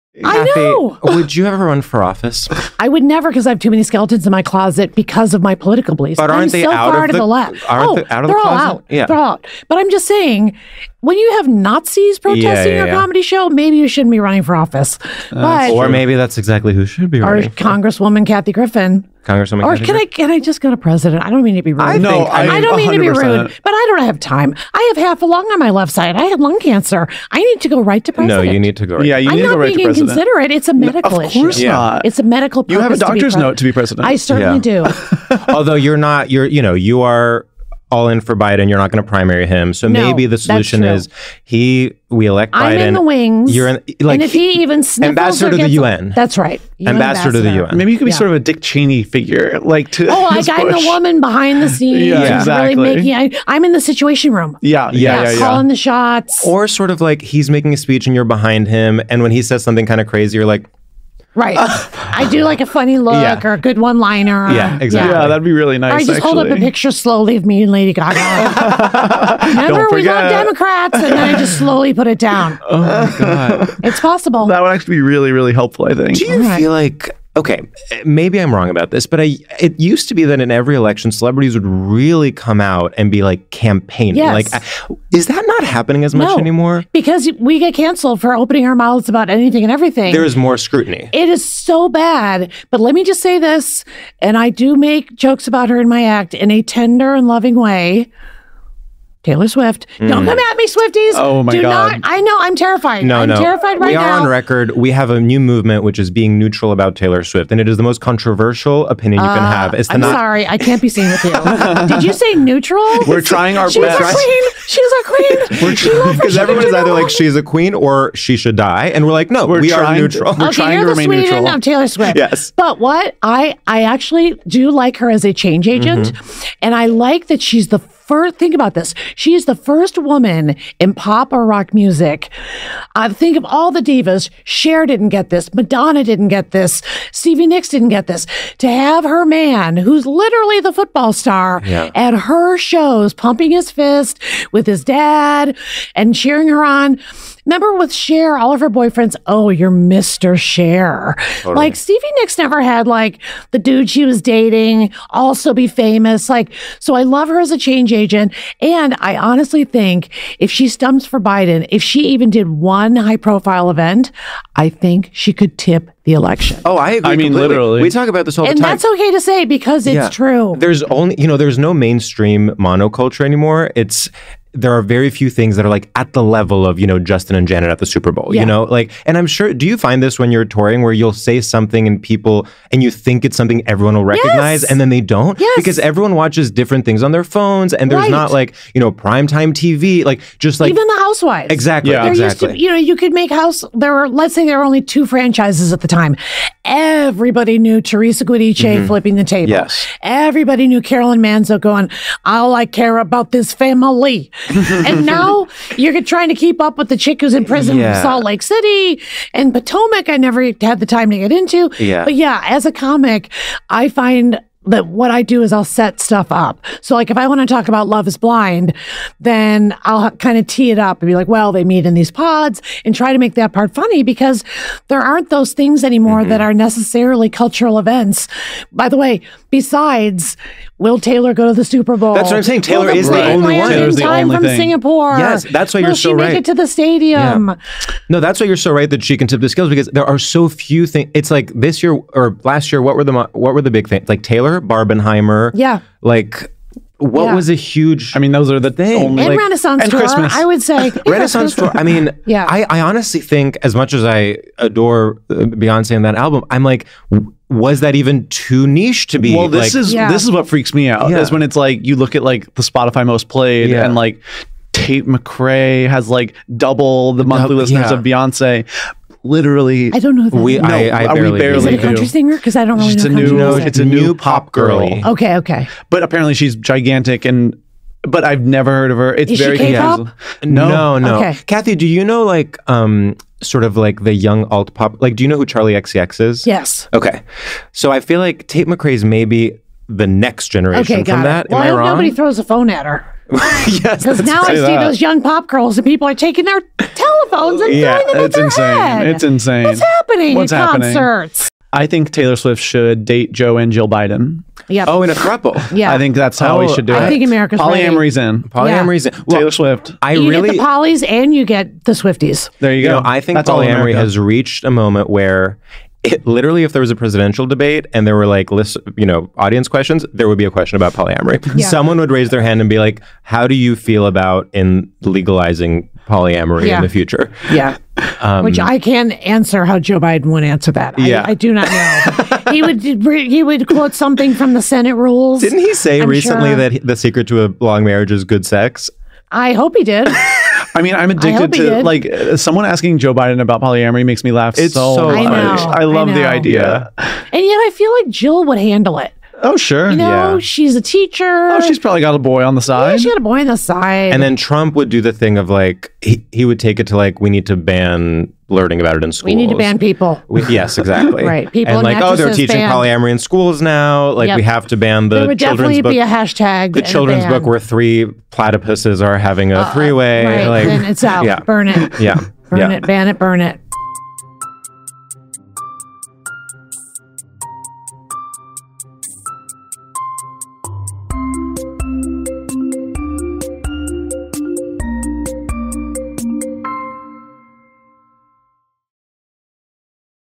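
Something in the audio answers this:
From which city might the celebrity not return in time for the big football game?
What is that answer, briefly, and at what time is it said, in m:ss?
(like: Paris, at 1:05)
Singapore, at 3:54.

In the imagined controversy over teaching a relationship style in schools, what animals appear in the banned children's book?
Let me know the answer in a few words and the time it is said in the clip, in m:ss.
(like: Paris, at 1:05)
platypuses, at 6:08.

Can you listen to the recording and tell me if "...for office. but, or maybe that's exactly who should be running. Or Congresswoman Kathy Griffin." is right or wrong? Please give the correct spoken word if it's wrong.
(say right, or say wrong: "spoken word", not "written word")
right.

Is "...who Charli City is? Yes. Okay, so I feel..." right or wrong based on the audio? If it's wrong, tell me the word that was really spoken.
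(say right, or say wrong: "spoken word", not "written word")
wrong: "XCX", not "City".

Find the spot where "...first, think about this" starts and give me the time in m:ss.
2:08.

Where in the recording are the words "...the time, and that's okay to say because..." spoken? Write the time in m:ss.
2:48.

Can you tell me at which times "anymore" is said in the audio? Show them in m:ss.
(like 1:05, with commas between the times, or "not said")
1:26, 2:53, 3:45.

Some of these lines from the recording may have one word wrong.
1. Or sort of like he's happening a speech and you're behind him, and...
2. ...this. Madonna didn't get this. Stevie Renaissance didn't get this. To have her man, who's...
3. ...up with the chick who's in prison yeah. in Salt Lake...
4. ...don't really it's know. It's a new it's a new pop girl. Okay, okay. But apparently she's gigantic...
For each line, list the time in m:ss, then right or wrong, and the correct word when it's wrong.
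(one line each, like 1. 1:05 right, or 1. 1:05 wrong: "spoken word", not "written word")
1. 0:56 wrong: "making", not "happening"
2. 2:15 wrong: "Nicks", not "Renaissance"
3. 3:26 right
4. 4:32 right.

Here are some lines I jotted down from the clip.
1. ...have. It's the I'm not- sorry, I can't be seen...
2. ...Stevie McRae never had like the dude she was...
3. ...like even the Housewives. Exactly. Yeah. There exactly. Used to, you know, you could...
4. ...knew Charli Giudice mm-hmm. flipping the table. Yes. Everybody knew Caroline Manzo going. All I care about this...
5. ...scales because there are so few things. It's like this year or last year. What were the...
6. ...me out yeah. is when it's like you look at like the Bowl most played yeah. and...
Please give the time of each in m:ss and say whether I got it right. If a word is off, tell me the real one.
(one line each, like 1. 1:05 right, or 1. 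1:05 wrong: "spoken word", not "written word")
1. 1:49 right
2. 2:31 wrong: "Nicks", not "McRae"
3. 3:10 right
4. 3:17 wrong: "Teresa", not "Charli"
5. 3:59 right
6. 4:20 wrong: "Spotify", not "Bowl".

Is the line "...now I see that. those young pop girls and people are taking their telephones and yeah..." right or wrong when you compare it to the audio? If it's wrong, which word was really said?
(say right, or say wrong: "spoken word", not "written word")
right.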